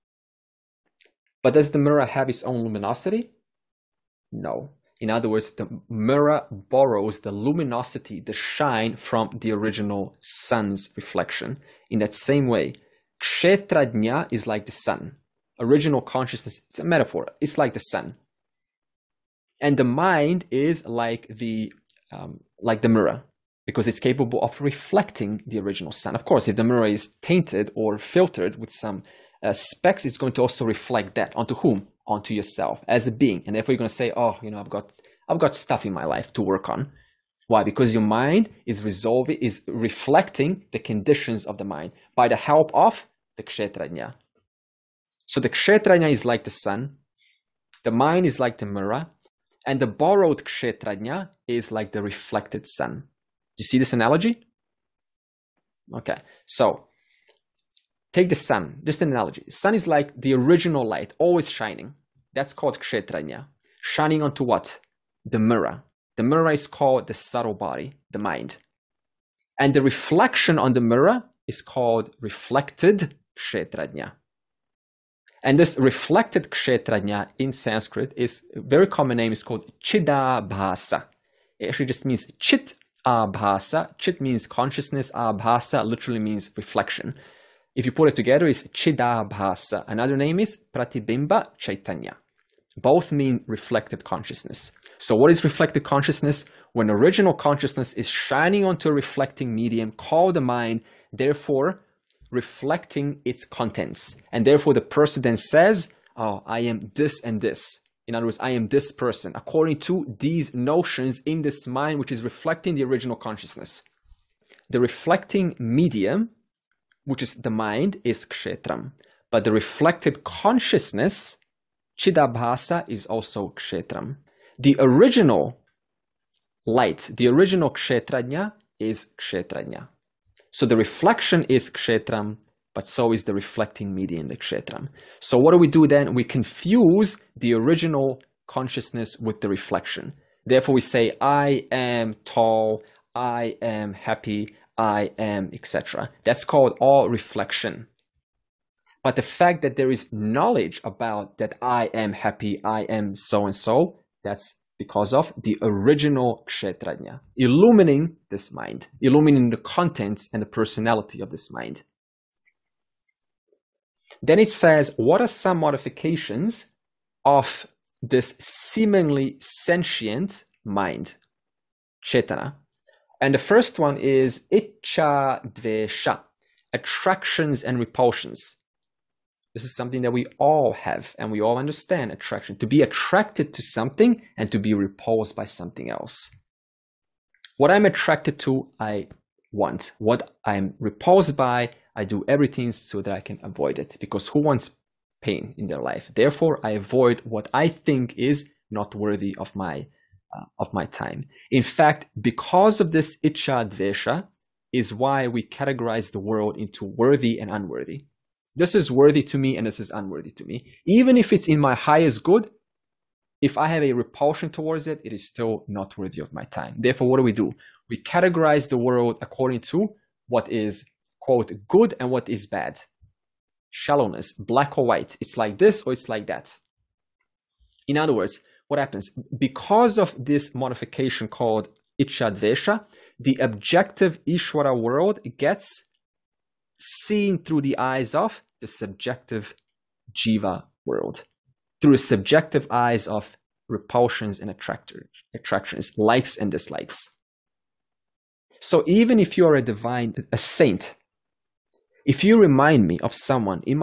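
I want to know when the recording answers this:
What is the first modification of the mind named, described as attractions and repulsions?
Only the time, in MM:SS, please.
02:54.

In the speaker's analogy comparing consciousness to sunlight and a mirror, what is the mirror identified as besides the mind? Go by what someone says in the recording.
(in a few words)
subtle body.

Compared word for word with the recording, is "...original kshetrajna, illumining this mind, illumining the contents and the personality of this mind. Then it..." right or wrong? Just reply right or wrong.
right.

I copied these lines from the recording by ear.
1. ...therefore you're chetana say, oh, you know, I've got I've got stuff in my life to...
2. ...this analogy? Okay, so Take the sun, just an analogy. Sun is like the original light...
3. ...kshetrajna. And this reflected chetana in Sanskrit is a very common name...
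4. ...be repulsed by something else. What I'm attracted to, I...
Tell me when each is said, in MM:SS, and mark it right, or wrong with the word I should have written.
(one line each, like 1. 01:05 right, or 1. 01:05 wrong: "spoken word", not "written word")
1. 00:33 wrong: "gonna", not "chetana"
2. 00:53 right
3. 01:13 wrong: "kshetrajna", not "chetana"
4. 03:04 right.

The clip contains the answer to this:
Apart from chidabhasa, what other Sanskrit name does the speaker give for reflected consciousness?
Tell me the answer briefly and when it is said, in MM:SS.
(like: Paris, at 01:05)
Pratibimba Chaitanya, at 01:30.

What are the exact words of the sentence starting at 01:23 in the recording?
Chit means consciousness, abhasa literally means reflection.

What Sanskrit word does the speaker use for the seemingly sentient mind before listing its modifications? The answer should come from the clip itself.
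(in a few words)
chetana.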